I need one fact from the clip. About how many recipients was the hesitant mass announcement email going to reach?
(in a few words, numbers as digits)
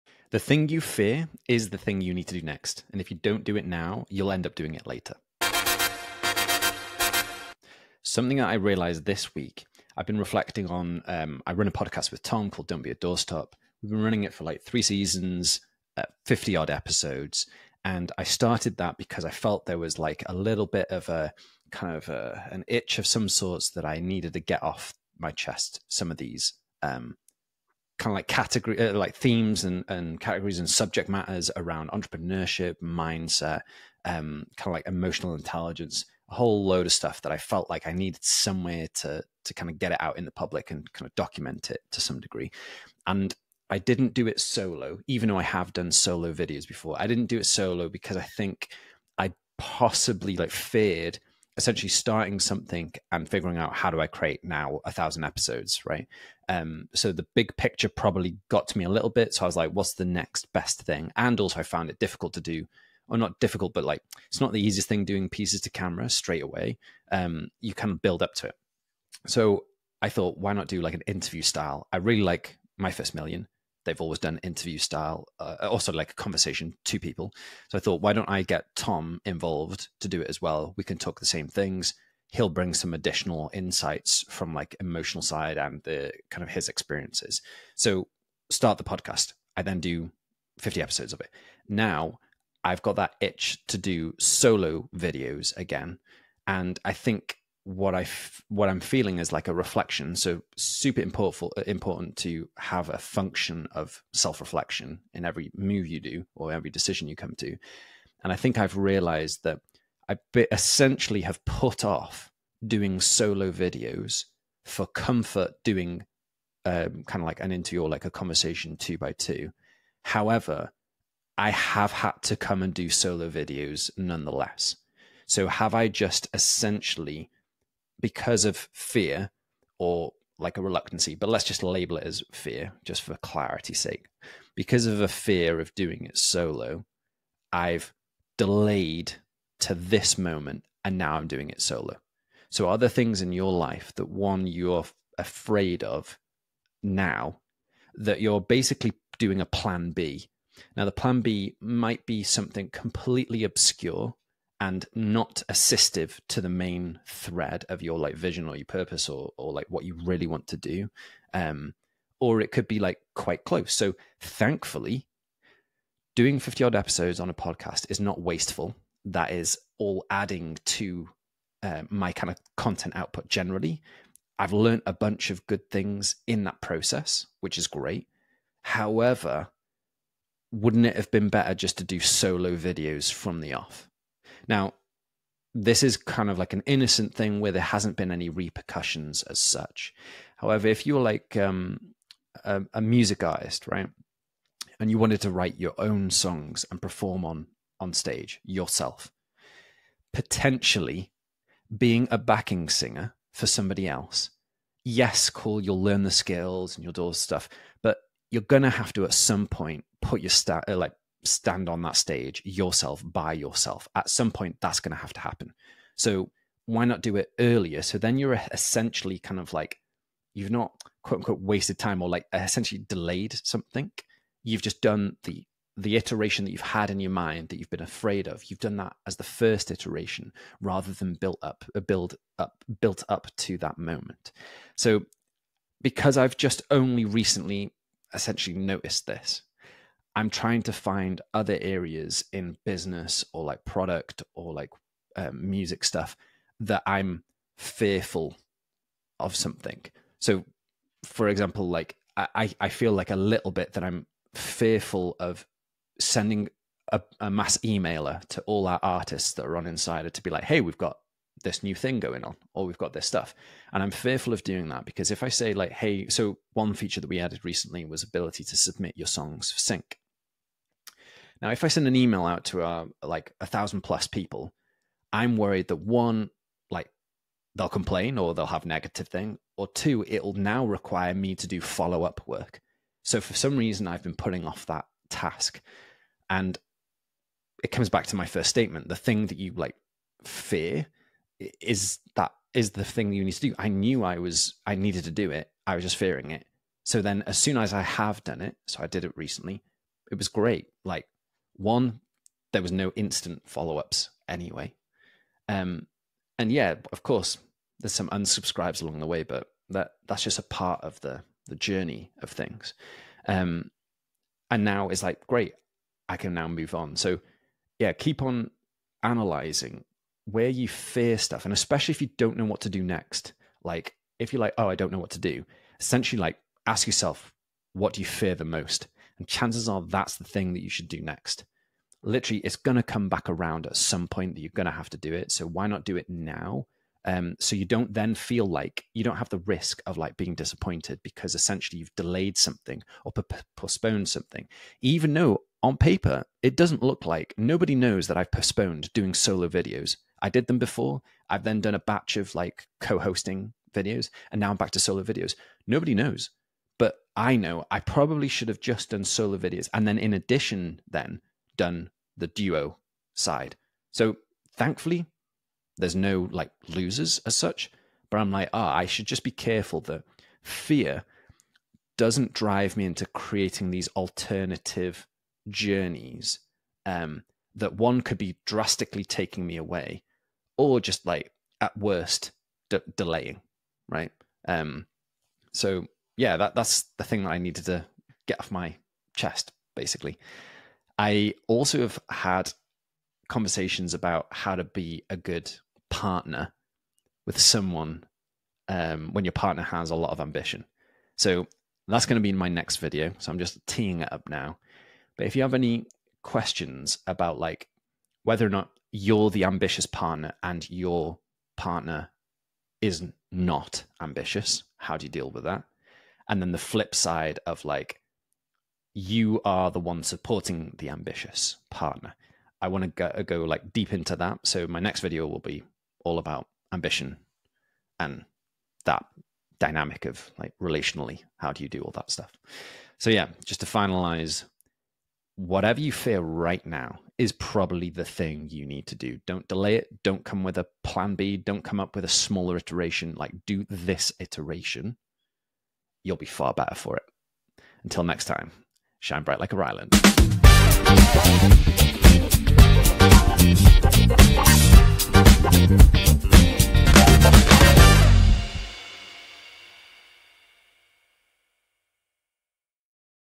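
a thousand plus.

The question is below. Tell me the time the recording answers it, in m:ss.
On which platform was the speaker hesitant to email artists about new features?
4:19.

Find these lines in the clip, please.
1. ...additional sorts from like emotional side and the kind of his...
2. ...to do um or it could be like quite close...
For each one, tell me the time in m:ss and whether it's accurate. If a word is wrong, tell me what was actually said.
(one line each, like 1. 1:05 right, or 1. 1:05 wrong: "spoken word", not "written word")
1. 1:22 wrong: "insights", not "sorts"
2. 2:40 right.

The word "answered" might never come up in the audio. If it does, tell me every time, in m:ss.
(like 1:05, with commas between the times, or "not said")
not said.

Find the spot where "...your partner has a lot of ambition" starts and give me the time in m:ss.
6:39.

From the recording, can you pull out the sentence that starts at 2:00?
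However, I have had to come and do solo videos nonetheless.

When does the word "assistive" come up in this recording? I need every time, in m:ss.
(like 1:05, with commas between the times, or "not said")
2:35.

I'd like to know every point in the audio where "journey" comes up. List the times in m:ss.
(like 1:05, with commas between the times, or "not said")
5:11, 6:15.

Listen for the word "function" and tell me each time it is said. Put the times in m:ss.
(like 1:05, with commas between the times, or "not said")
1:42.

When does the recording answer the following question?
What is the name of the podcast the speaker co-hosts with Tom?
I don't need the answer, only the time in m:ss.
0:12.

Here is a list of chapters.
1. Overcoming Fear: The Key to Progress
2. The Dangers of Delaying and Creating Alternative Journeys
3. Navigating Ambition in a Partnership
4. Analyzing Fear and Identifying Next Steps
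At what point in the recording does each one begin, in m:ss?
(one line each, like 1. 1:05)
1. 5:43
2. 2:17
3. 6:13
4. 4:13.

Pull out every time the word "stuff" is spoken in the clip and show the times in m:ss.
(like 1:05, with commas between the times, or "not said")
0:36, 3:27, 4:05, 4:23, 5:21, 7:12.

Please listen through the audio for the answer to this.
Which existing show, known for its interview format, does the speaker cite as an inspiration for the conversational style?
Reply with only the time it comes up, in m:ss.
1:12.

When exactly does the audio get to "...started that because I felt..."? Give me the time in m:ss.
0:18.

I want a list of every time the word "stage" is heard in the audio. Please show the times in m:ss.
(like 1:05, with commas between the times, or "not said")
3:17, 3:31.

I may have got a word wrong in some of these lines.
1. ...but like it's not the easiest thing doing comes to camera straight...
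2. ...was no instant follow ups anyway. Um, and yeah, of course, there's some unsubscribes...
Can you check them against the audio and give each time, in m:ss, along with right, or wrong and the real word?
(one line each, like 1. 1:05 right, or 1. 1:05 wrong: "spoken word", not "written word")
1. 1:03 wrong: "pieces", not "comes"
2. 5:02 right.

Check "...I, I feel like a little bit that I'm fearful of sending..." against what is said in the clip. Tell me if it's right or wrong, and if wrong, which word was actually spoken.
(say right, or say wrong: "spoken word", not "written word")
right.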